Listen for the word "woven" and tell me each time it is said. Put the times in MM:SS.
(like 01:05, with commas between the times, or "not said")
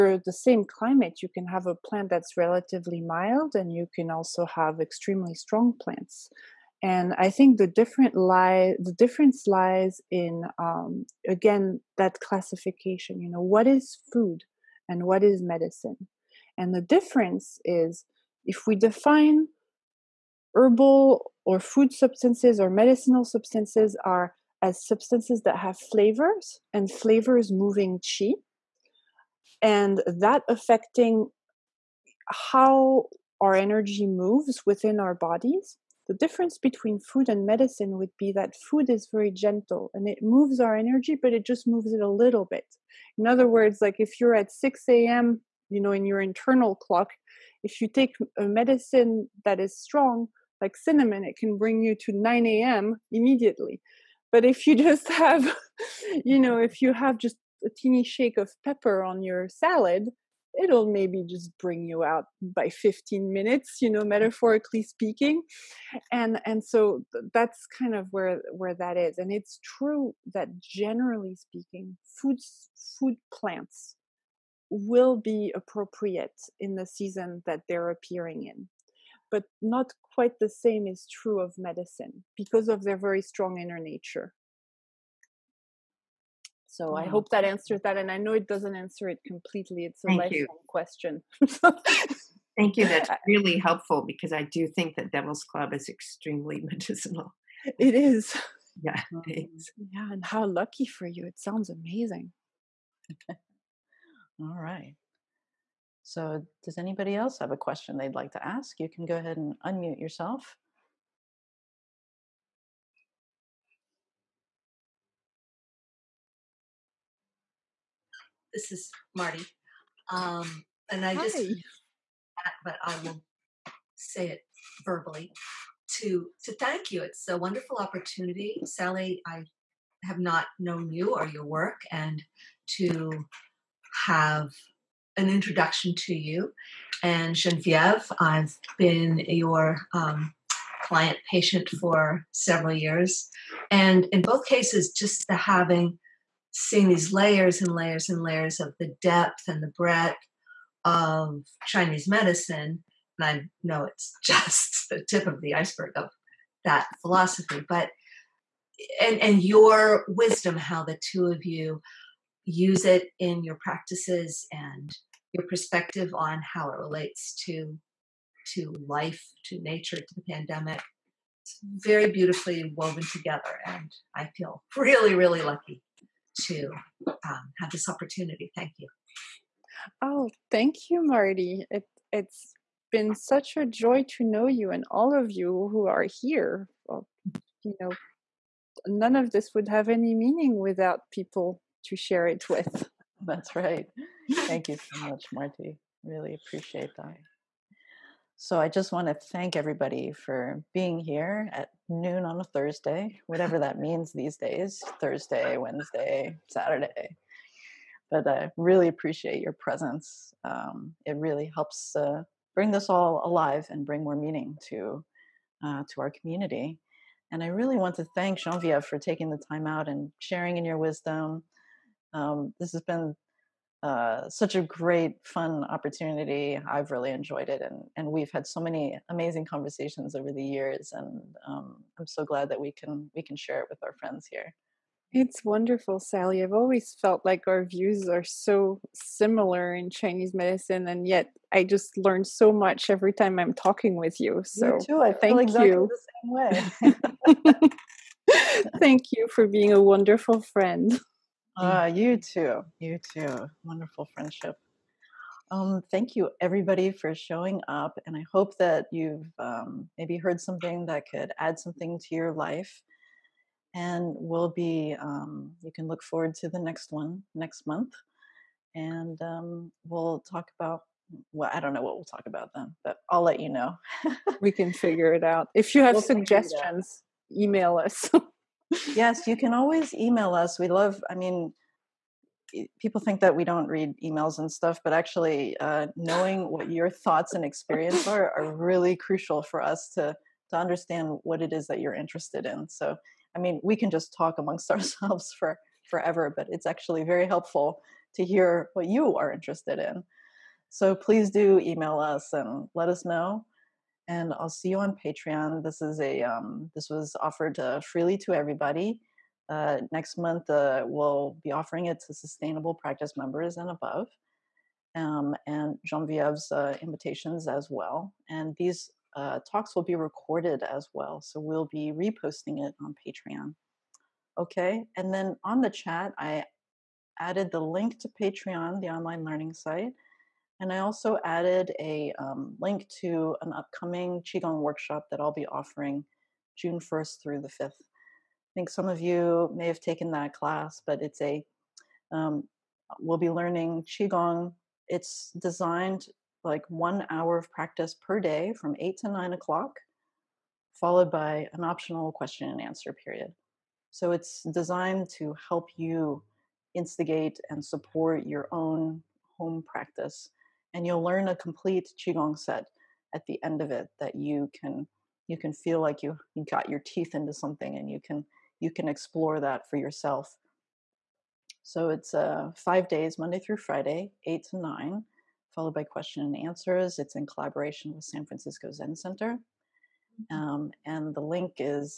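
02:52.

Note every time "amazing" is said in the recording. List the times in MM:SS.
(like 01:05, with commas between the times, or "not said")
01:41, 03:49.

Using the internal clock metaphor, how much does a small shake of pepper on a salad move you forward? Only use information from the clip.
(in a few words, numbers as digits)
15 minutes.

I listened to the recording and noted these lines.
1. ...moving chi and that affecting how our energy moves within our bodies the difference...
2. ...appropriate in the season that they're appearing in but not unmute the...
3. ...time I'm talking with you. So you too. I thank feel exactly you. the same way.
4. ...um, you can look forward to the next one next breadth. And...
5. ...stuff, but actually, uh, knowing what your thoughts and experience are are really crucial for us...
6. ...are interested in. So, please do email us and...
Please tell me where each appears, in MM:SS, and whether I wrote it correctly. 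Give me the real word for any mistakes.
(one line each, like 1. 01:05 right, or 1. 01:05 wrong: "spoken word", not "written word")
1. 00:27 right
2. 01:15 wrong: "quite", not "unmute"
3. 04:03 right
4. 04:24 wrong: "month", not "breadth"
5. 04:44 right
6. 04:59 right.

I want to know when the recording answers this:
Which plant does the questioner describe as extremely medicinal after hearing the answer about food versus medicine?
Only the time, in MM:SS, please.
01:35.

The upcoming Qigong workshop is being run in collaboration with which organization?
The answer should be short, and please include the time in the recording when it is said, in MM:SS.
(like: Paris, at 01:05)
San Francisco Zen Center, at 06:18.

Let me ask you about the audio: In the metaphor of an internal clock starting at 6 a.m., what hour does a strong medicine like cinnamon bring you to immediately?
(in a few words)
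9 a.m.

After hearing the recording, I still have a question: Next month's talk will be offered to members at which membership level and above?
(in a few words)
sustainable practice.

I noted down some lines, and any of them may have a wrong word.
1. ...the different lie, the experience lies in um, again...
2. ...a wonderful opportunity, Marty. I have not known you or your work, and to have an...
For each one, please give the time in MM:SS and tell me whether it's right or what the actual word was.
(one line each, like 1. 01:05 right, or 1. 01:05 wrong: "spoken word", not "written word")
1. 00:07 wrong: "difference", not "experience"
2. 02:07 wrong: "Sally", not "Marty".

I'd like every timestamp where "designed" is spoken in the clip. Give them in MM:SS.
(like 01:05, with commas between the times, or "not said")
05:45, 05:54.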